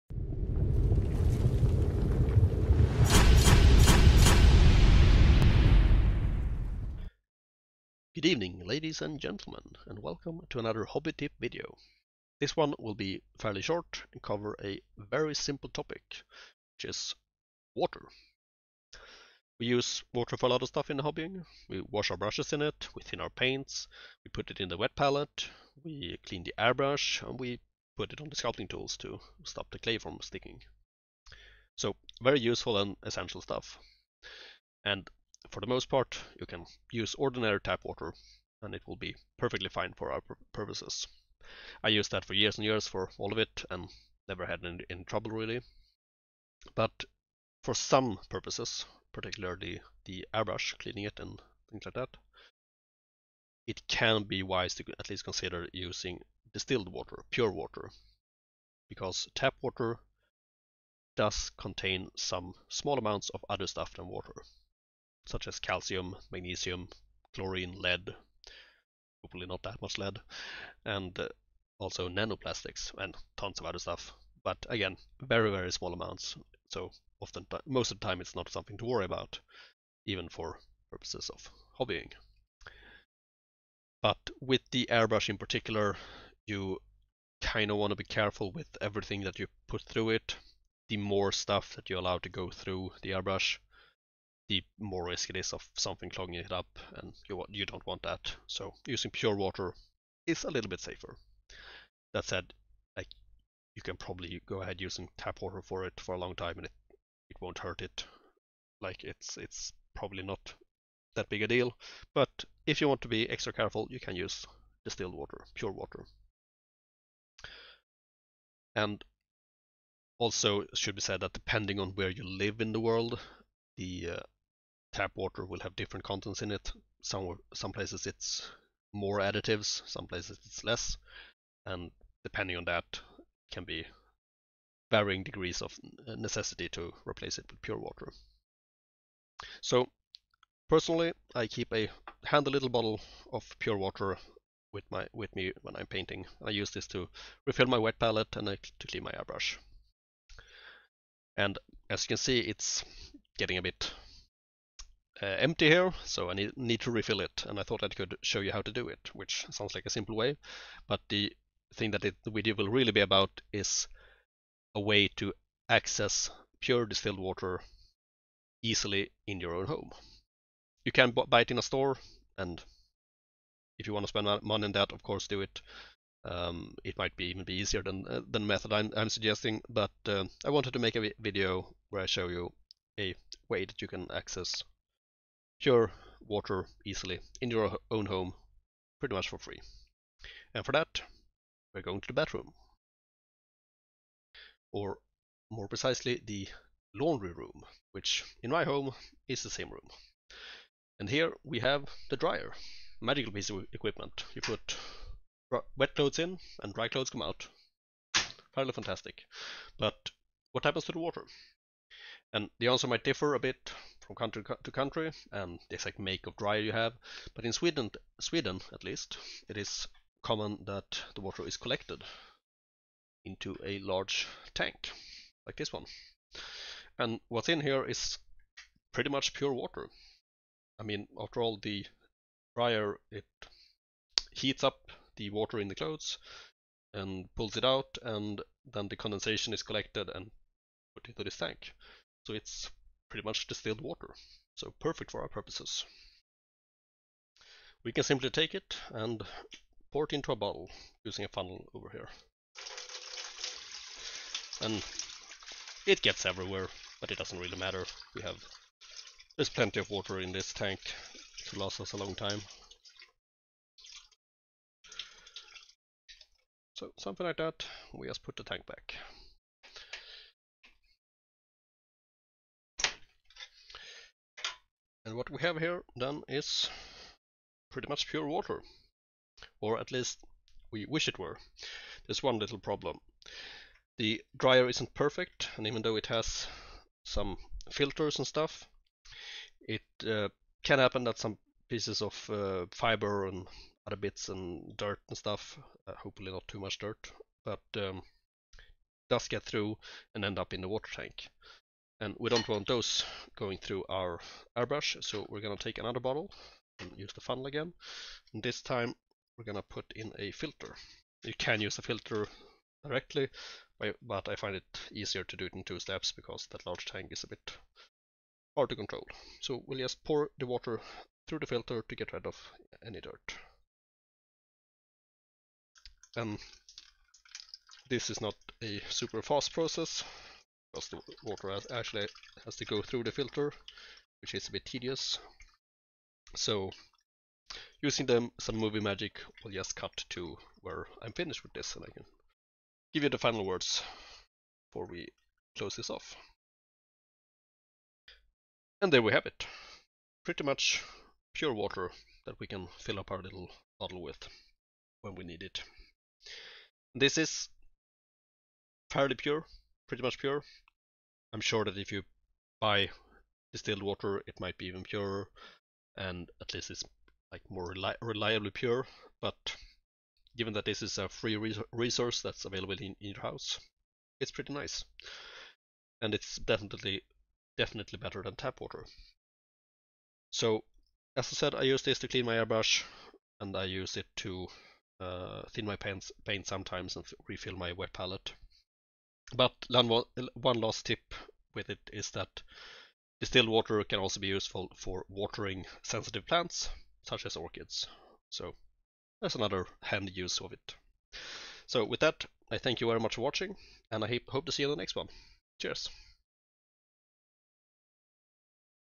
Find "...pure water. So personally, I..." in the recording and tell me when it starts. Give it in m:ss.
2:17.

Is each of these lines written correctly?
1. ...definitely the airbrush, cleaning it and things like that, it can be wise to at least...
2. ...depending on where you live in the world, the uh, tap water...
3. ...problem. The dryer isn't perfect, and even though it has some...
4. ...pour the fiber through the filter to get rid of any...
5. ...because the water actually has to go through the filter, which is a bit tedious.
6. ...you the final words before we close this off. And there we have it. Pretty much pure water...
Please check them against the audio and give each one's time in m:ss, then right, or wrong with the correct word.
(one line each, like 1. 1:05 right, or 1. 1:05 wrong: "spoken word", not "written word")
1. 0:49 wrong: "particularly", not "definitely"
2. 2:01 right
3. 4:42 right
4. 5:20 wrong: "water", not "fiber"
5. 5:30 right
6. 5:43 right.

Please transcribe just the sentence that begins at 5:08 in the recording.
And this time we're going to put in a filter.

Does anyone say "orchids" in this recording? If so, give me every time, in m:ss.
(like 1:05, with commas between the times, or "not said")
6:37.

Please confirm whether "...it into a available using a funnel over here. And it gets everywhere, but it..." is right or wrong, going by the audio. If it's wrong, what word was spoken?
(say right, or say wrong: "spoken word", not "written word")
wrong: "bottle", not "available".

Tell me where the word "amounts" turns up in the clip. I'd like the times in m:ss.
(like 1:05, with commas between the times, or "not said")
1:02, 1:15.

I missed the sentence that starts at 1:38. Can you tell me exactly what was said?
So using pure water is a little bit safer.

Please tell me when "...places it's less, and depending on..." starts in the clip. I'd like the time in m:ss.
2:10.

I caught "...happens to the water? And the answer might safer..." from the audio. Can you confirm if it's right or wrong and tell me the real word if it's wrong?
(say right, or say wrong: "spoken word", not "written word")
wrong: "differ", not "safer".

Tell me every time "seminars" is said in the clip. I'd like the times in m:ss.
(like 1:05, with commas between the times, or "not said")
not said.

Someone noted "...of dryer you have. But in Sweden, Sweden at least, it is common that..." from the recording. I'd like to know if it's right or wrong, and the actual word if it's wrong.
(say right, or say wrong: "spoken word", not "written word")
right.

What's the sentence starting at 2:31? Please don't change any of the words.
And as you can see, it's getting a bit uh, empty here, so I need, need to refill it.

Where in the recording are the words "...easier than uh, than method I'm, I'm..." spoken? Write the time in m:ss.
2:57.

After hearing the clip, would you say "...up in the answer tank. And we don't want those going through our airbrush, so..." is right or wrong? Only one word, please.
wrong.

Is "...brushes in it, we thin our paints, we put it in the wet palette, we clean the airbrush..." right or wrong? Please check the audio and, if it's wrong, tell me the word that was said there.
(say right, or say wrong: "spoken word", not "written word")
right.